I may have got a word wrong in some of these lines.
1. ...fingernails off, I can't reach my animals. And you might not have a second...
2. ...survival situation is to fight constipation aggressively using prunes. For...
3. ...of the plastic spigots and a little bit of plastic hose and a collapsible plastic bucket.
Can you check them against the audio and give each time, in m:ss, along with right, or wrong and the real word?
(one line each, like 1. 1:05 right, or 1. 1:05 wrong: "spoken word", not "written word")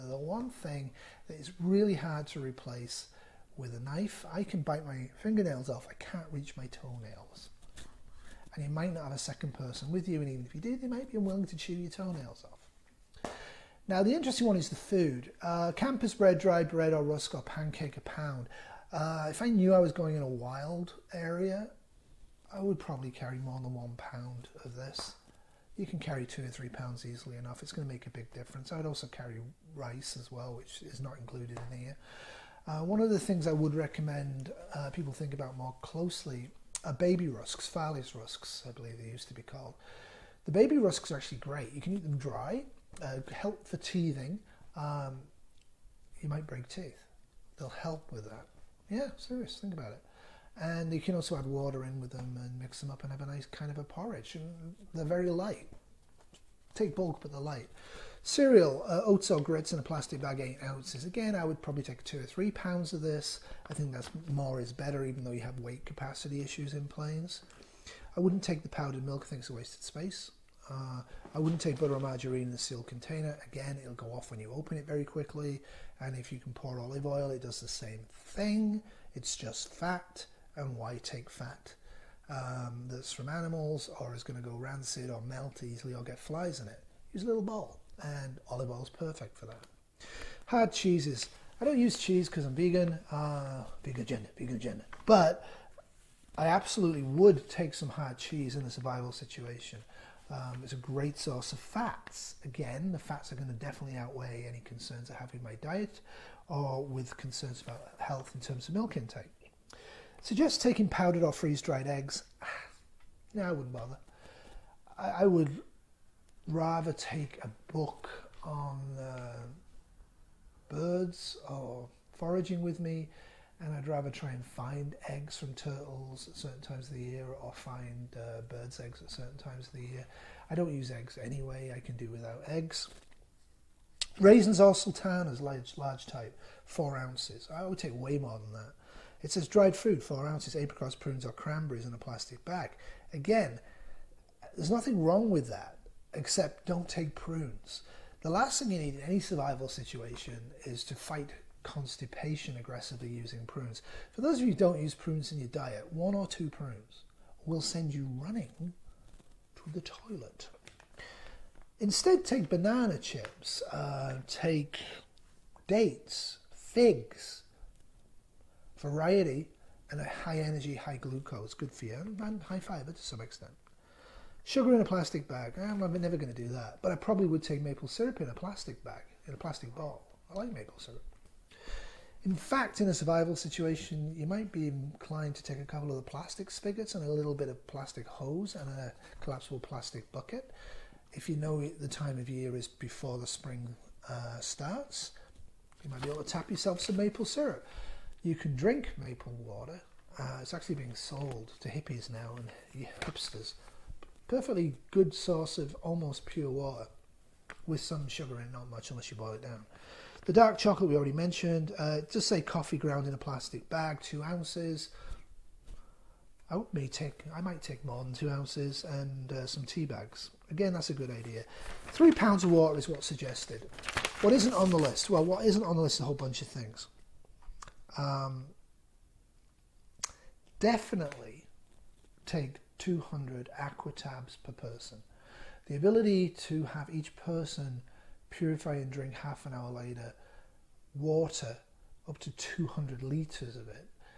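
1. 0:05 wrong: "toenails", not "animals"
2. 2:29 right
3. 3:05 right.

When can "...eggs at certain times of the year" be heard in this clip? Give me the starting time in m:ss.
2:08.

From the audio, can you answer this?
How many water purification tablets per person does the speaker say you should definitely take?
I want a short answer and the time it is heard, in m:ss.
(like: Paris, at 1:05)
200, at 3:52.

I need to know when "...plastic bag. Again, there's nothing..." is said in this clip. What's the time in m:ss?
2:21.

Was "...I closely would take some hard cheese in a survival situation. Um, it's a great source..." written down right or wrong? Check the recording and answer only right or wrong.
wrong.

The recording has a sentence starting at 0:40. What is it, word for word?
The baby rusks are actually great.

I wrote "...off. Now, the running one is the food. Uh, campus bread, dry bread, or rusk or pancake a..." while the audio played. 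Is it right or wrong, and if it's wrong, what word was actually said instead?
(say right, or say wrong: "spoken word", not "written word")
wrong: "interesting", not "running".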